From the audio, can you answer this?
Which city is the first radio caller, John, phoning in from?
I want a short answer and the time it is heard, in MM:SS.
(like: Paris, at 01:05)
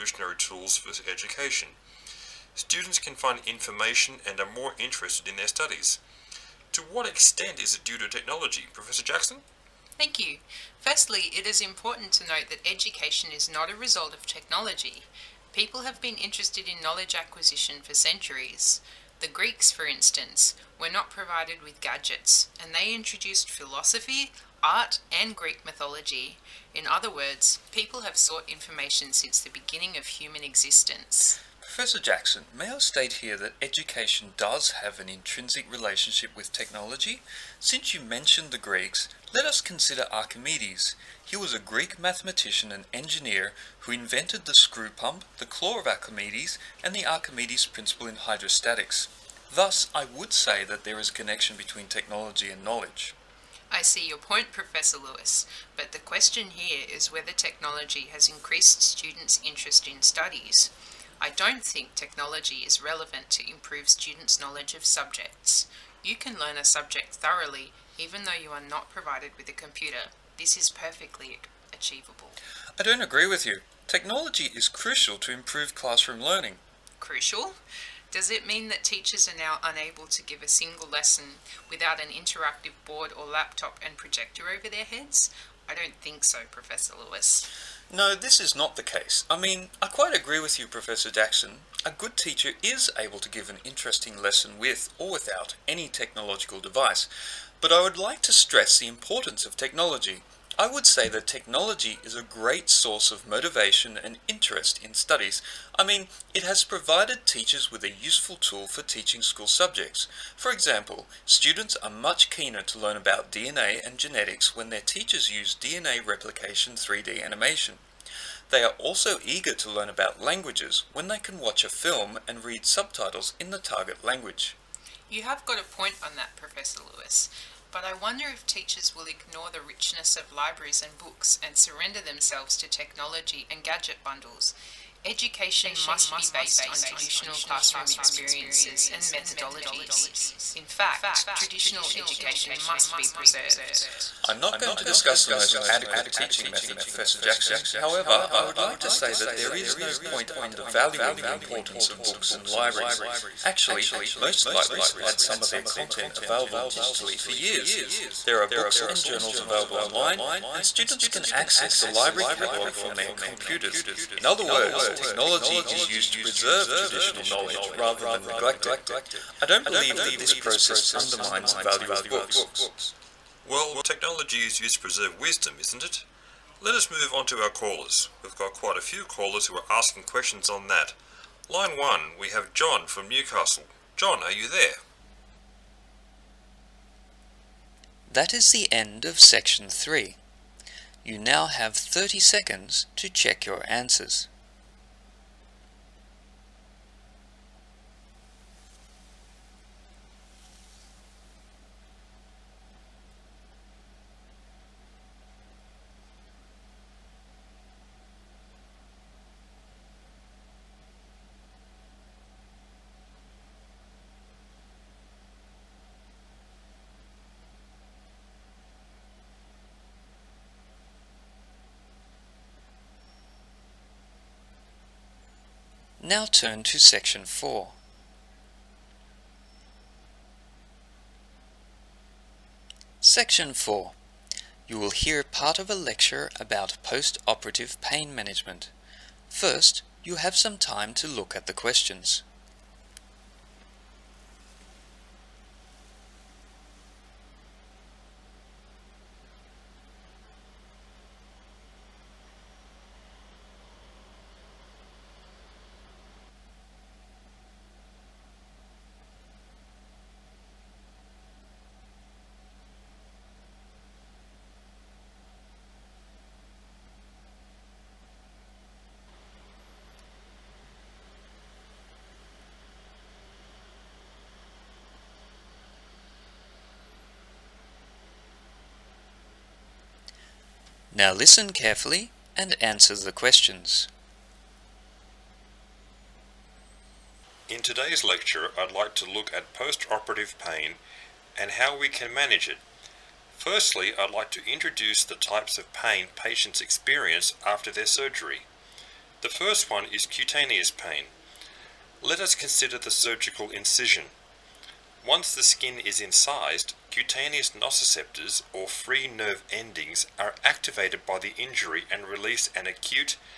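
Newcastle, at 03:03.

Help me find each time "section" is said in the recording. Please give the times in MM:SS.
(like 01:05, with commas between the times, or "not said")
03:09, 03:46, 03:52.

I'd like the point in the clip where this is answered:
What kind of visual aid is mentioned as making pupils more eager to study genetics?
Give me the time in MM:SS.
01:55.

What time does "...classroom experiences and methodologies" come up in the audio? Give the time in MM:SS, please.
02:17.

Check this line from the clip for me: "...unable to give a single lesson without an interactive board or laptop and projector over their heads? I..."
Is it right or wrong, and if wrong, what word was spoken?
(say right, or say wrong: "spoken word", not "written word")
right.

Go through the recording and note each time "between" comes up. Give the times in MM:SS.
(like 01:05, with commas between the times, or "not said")
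00:51.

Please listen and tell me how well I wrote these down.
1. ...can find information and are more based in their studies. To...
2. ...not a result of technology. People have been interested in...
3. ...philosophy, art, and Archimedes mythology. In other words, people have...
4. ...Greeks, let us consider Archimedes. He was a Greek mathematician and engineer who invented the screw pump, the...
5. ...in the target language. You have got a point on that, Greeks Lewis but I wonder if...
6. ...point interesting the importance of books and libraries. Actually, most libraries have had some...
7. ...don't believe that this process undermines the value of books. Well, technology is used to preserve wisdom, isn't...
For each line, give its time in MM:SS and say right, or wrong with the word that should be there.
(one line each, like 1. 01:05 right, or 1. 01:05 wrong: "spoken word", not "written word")
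1. 00:02 wrong: "interested", not "based"
2. 00:13 right
3. 00:23 wrong: "Greek", not "Archimedes"
4. 00:38 right
5. 02:03 wrong: "Professor", not "Greeks"
6. 02:30 wrong: "undervaluing", not "interesting"
7. 02:49 right.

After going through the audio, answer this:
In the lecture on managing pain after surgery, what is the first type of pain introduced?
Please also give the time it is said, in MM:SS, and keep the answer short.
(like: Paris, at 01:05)
cutaneous pain, at 05:00.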